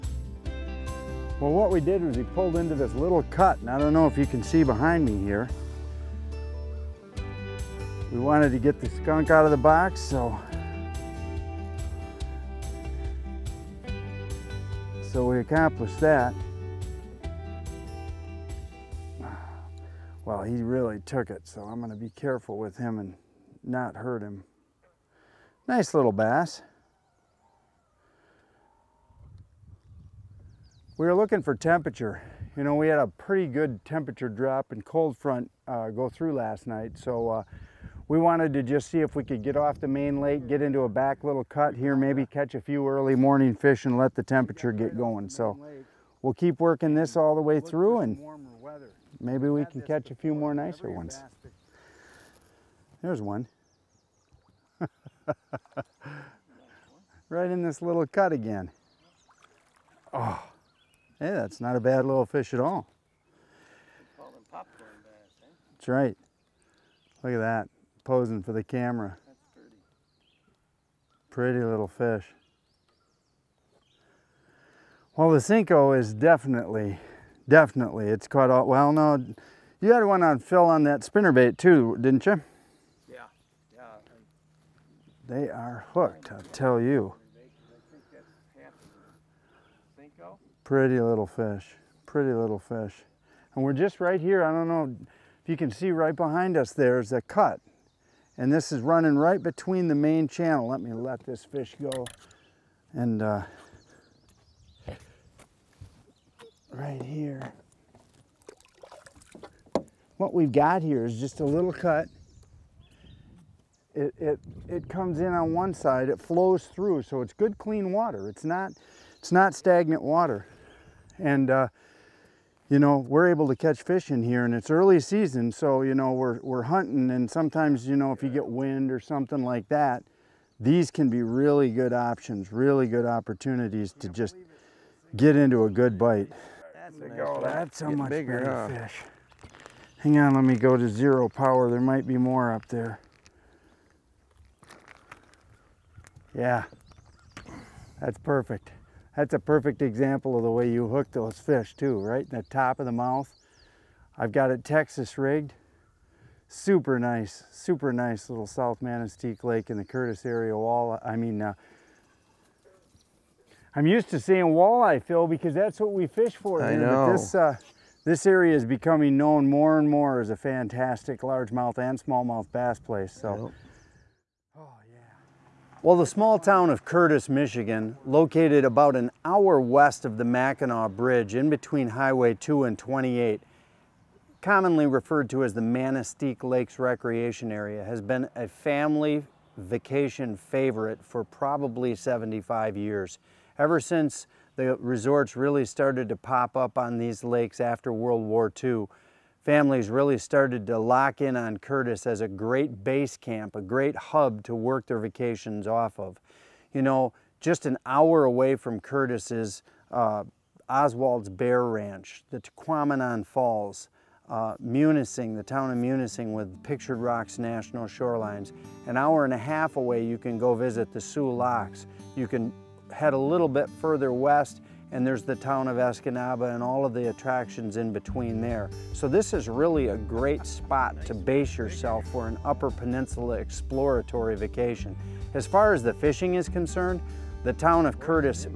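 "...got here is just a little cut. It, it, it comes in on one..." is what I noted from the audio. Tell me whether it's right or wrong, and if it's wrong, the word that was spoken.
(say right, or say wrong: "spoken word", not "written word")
right.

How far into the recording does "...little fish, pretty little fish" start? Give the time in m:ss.
1:30.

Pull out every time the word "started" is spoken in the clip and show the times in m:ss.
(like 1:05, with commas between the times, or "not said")
3:15, 3:20.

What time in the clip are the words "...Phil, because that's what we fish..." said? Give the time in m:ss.
2:45.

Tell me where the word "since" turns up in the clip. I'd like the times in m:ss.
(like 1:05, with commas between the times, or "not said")
3:13.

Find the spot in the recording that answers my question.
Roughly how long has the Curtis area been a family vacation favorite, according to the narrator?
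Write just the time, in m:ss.
3:11.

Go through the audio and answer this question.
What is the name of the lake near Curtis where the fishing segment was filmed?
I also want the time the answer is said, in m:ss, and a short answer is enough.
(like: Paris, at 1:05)
South Manistique Lake, at 2:38.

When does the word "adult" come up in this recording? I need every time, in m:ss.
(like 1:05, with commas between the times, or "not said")
not said.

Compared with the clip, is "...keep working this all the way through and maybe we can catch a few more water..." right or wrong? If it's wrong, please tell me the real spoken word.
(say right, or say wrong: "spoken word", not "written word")
wrong: "nicer", not "water".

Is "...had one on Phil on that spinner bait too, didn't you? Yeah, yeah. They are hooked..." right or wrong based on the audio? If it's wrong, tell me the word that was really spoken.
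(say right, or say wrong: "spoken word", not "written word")
right.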